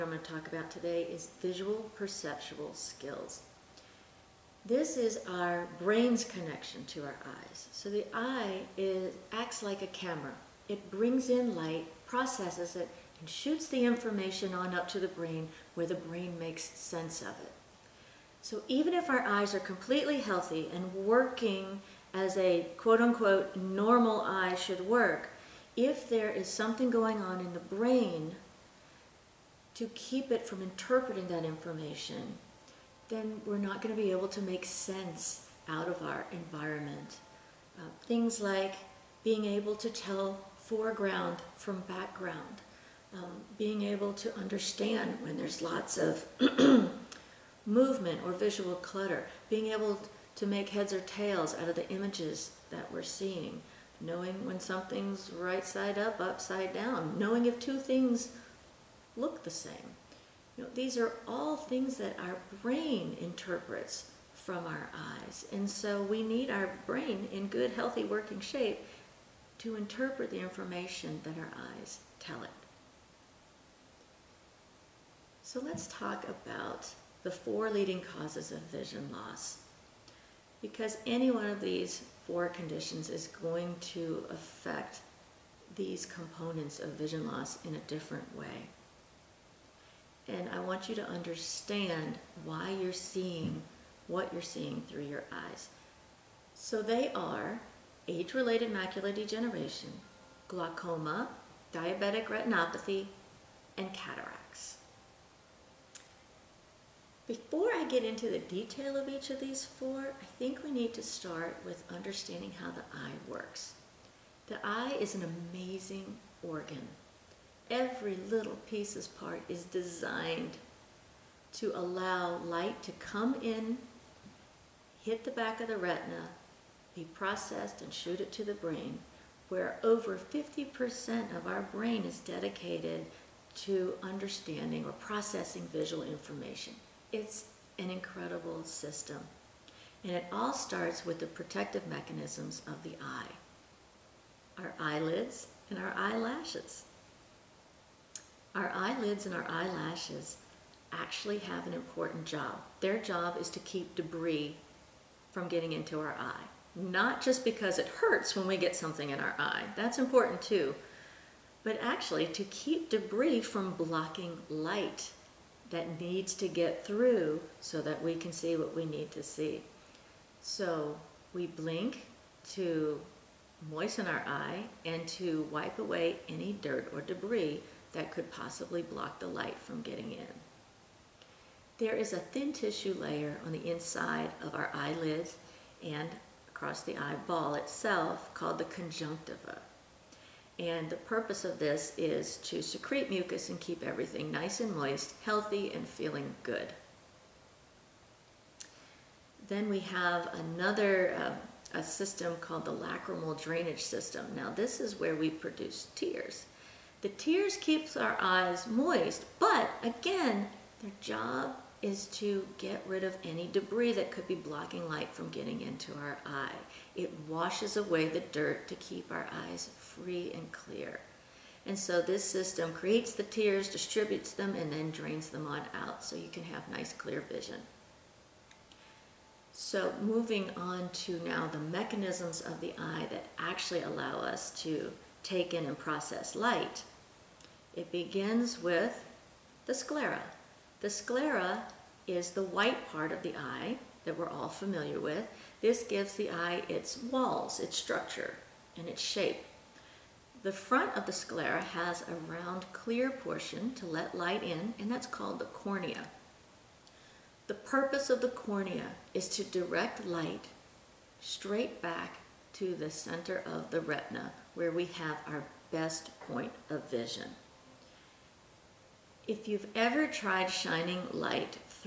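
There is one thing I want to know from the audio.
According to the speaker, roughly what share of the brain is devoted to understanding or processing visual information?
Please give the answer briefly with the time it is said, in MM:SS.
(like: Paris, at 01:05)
over 50%, at 02:09.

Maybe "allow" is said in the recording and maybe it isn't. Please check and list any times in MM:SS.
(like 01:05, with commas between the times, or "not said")
02:01, 03:53.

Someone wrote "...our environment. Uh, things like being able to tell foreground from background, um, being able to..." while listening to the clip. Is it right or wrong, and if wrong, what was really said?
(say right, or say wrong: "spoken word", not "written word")
right.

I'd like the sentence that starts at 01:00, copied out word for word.
You know, these are all things that our brain interprets from our eyes.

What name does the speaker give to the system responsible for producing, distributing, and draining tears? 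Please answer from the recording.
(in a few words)
lacrimal drainage system.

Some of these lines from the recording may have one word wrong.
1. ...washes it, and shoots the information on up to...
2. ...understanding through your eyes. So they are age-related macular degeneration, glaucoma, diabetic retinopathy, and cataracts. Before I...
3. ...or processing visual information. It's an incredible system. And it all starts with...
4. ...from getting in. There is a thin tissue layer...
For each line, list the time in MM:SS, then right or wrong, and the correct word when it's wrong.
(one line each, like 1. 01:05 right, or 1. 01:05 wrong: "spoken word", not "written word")
1. 00:12 wrong: "processes", not "washes"
2. 01:34 wrong: "seeing", not "understanding"
3. 02:14 right
4. 02:59 right.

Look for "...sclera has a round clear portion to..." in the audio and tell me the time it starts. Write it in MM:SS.
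04:11.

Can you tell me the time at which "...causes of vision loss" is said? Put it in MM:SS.
01:17.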